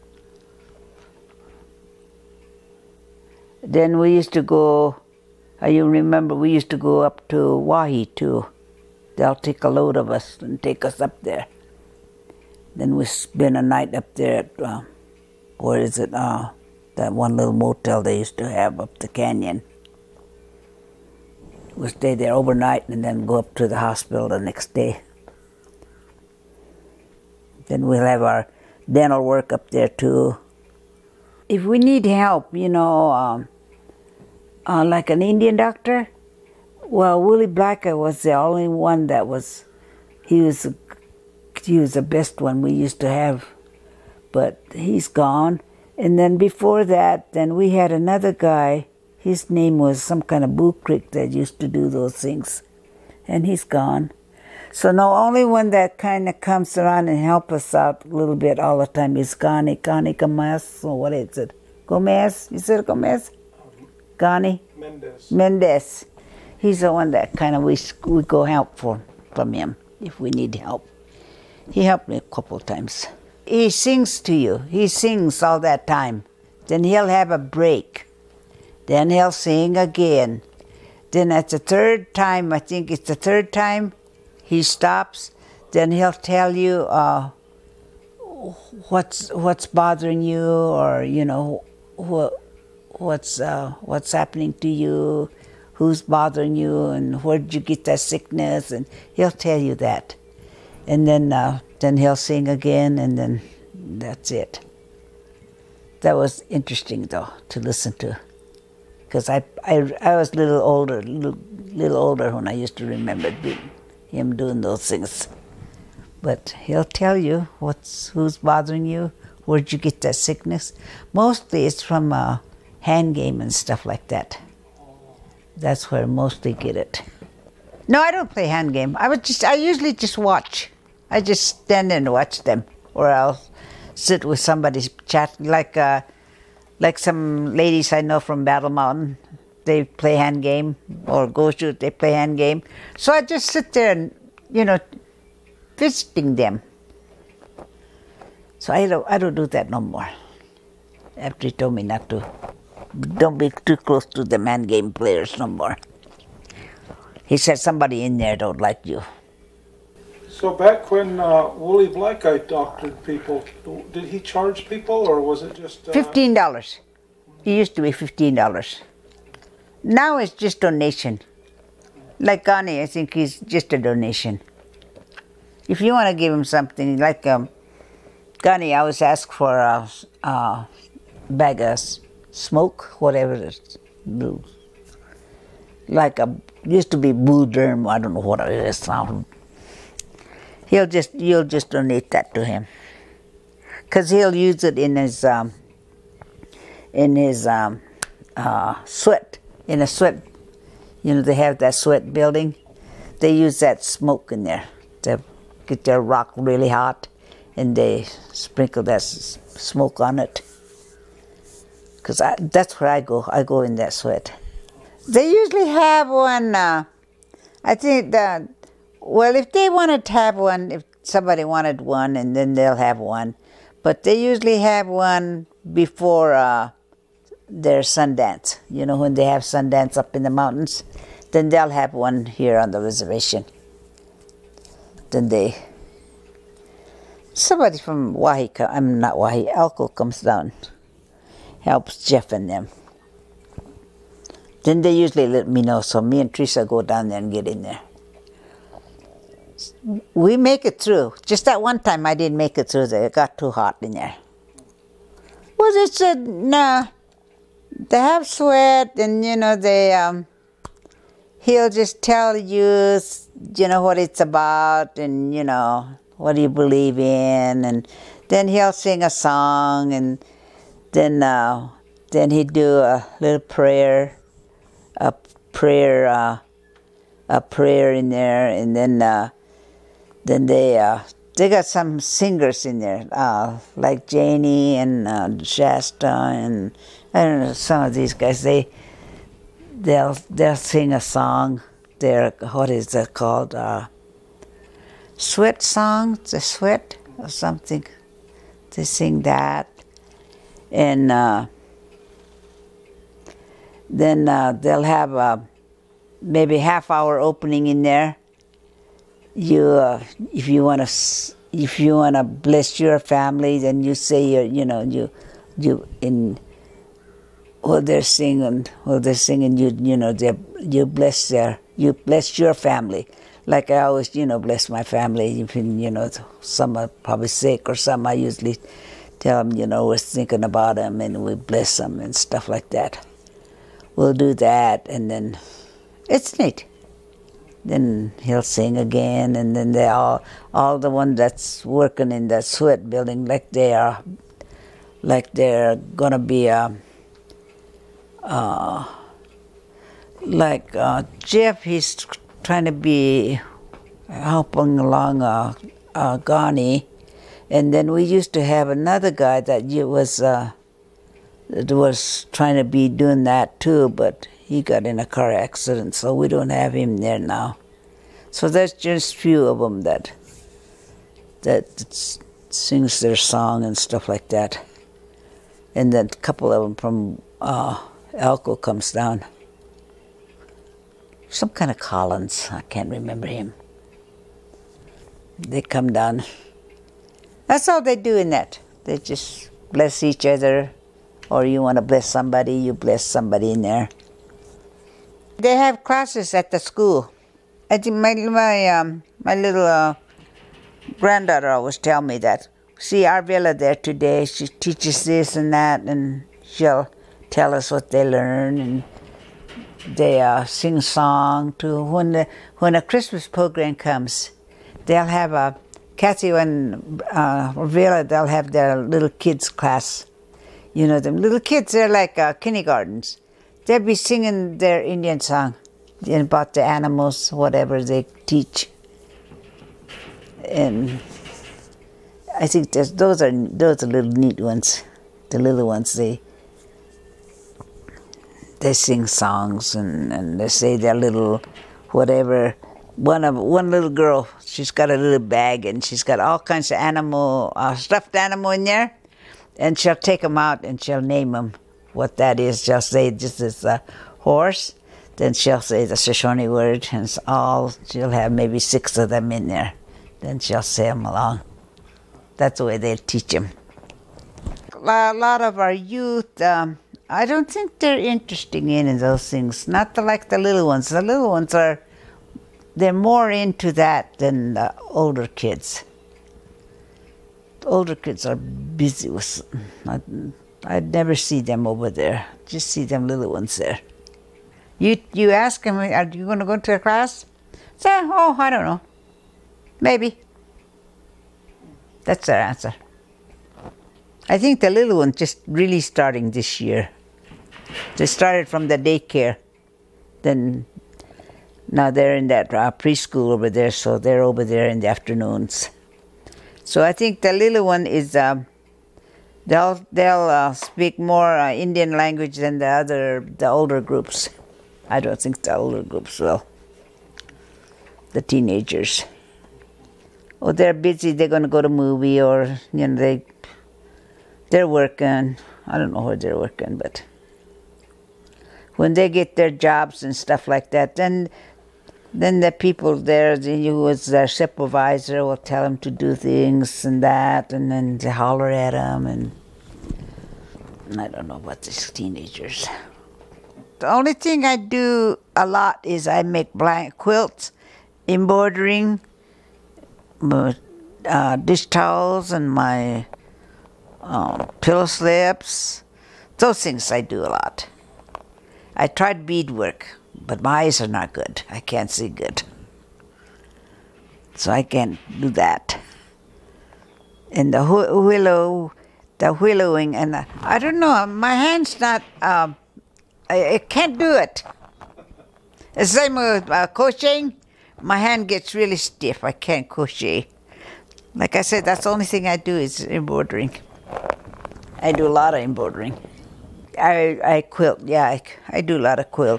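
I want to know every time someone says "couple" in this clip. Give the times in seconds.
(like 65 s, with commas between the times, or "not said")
72 s, 376 s.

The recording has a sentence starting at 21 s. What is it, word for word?
We stay there overnight and then go up to the hospital the next day.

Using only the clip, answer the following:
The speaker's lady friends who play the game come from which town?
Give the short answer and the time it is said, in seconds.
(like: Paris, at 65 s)
Battle Mountain, at 138 s.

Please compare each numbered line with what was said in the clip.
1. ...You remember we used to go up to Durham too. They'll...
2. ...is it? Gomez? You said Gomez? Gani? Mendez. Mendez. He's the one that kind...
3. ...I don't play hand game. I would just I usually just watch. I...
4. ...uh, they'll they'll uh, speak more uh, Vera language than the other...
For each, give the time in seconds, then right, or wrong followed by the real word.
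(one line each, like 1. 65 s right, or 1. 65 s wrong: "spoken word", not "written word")
1. 5 s wrong: "Owyhee", not "Durham"
2. 61 s right
3. 128 s right
4. 508 s wrong: "Indian", not "Vera".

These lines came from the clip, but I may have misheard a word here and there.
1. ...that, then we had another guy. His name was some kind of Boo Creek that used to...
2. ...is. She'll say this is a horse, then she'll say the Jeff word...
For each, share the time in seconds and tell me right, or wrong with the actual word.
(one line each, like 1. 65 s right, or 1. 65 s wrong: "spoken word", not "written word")
1. 46 s right
2. 452 s wrong: "Shoshone", not "Jeff".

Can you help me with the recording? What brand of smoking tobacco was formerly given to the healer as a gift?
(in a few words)
Bull Durham.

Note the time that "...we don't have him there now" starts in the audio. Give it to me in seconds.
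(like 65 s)
366 s.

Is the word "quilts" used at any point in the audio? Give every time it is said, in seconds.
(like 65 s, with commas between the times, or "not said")
546 s, 587 s.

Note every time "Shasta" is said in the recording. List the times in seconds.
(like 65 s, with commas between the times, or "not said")
285 s.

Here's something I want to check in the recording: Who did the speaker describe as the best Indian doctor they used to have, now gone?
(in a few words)
Willie Blacker.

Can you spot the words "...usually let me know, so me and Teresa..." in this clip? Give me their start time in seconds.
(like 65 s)
244 s.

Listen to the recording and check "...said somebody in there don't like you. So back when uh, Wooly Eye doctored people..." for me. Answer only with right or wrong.
right.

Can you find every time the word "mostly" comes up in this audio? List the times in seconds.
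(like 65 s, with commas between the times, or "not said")
121 s, 126 s.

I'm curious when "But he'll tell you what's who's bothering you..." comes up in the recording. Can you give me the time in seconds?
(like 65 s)
116 s.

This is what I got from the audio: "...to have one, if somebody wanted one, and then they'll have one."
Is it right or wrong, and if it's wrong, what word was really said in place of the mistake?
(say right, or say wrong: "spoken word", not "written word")
right.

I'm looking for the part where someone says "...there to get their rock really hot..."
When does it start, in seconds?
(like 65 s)
204 s.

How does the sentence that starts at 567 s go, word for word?
And the willow, the willowing, and the, I don't know, my hand's not, um, I, I, can't do it.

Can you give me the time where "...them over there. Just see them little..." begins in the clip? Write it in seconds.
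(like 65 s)
481 s.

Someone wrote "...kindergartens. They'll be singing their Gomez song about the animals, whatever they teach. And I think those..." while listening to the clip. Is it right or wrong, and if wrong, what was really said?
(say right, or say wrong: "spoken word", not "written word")
wrong: "Indian", not "Gomez".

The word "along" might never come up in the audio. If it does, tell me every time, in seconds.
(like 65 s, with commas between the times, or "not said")
354 s, 461 s.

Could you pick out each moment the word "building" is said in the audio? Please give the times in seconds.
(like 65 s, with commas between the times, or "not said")
202 s, 342 s.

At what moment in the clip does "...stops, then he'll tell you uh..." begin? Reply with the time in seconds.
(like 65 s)
84 s.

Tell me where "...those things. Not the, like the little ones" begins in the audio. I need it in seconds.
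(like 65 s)
468 s.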